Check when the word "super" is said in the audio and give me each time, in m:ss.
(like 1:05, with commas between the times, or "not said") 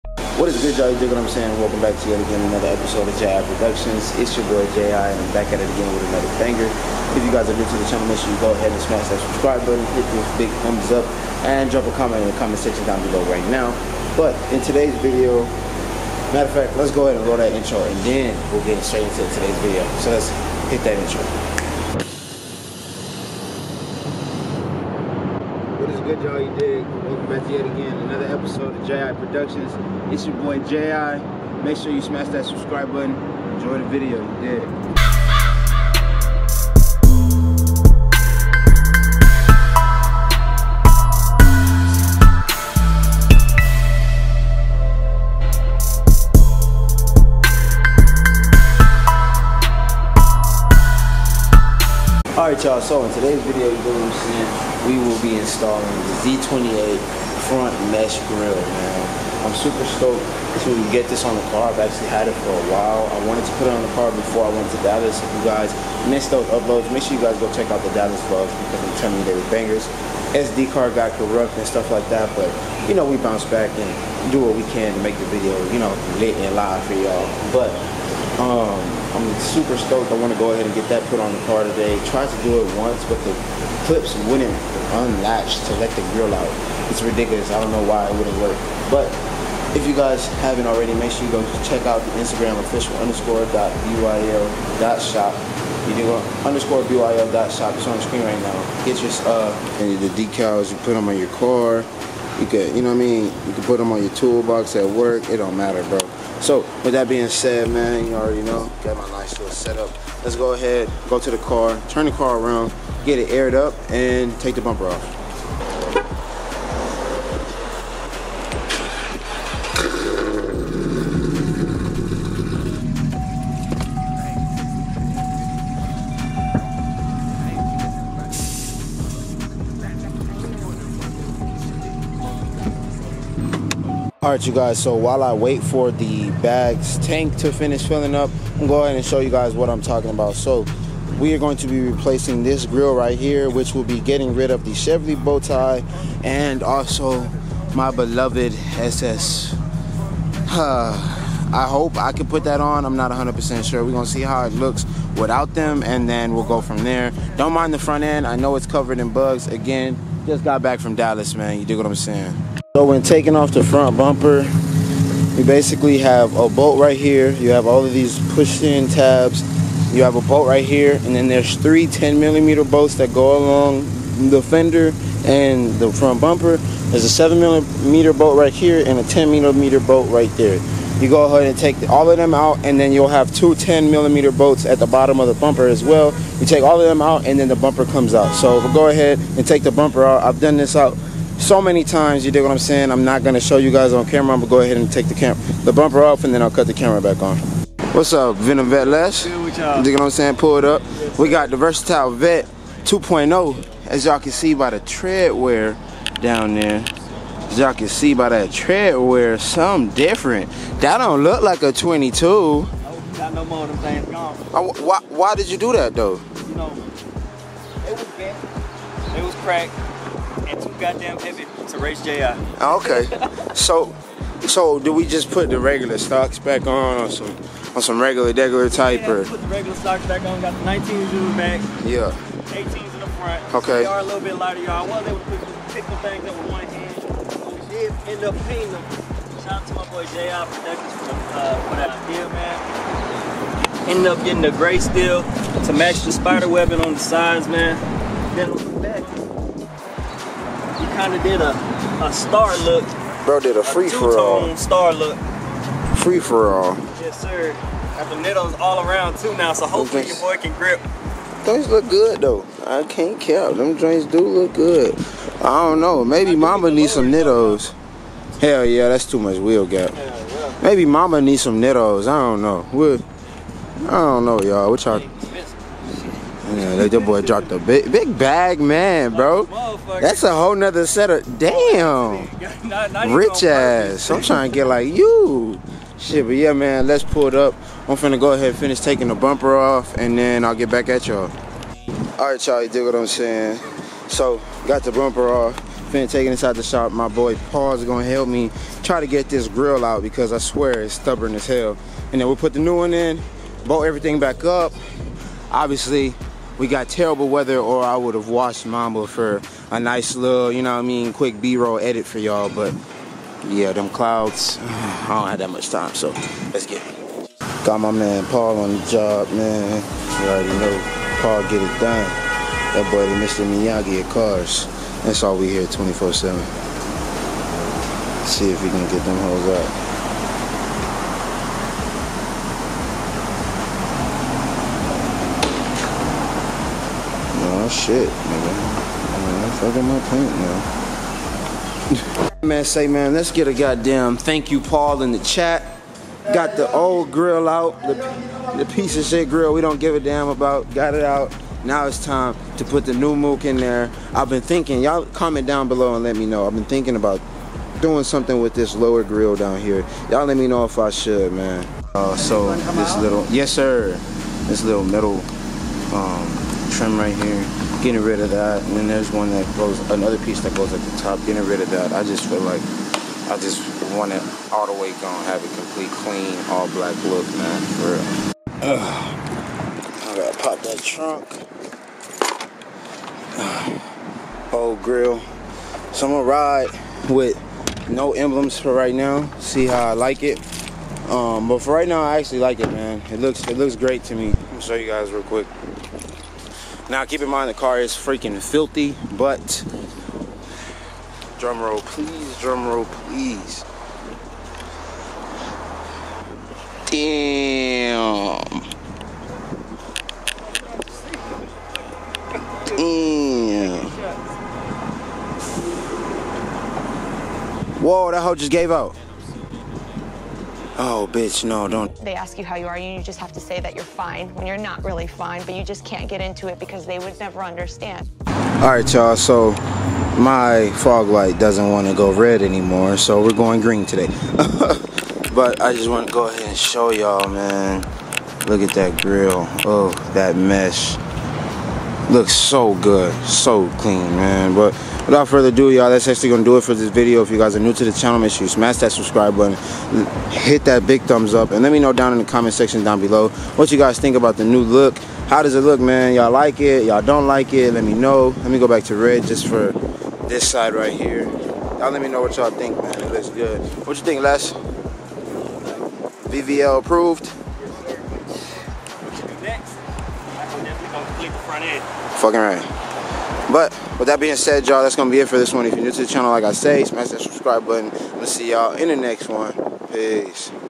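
0:59, 1:19.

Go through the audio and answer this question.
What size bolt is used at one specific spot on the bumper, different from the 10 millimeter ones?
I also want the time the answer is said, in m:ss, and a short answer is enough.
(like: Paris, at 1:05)
7 millimeter, at 2:57.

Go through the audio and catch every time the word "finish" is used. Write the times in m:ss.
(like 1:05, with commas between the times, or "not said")
2:17, 4:48.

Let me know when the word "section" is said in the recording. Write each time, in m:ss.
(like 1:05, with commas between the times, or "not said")
0:12, 7:32.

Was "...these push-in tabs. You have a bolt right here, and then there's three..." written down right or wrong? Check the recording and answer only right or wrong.
right.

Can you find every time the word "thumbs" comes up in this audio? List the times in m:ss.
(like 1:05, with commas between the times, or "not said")
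0:10, 7:31.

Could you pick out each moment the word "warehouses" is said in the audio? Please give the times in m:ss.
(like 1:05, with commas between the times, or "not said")
not said.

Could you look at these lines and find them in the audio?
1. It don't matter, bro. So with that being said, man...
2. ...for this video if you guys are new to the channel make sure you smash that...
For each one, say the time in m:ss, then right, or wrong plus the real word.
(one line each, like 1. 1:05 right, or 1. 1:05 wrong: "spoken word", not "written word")
1. 1:45 right
2. 7:26 right.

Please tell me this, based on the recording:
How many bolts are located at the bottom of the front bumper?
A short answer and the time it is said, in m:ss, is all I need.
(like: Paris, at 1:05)
2, at 3:03.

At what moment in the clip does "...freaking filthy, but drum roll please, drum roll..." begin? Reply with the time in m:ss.
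6:37.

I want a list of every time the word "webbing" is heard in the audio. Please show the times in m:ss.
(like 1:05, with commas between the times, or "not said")
4:06.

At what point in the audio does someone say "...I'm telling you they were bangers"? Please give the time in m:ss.
1:08.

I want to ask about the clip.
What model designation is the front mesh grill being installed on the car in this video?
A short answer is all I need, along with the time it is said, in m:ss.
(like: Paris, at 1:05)
Z28, at 0:56.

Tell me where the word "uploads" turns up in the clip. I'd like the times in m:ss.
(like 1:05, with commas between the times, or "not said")
1:06.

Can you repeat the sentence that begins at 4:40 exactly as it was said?
That's a whole nother set of damn.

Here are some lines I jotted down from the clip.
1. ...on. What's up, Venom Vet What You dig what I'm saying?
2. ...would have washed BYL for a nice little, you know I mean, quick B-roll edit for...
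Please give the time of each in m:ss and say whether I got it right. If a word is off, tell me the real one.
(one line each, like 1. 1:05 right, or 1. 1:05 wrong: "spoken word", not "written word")
1. 3:17 right
2. 5:07 wrong: "Mamba", not "BYL".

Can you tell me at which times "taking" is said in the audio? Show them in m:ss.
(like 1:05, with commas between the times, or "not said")
2:43, 4:48.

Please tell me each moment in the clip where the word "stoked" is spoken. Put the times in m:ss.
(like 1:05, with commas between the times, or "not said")
1:00, 1:19.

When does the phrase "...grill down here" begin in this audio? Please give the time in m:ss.
5:59.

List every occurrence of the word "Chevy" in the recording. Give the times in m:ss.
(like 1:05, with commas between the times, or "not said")
2:24.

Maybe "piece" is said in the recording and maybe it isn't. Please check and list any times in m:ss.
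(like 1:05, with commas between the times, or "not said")
5:48, 6:10.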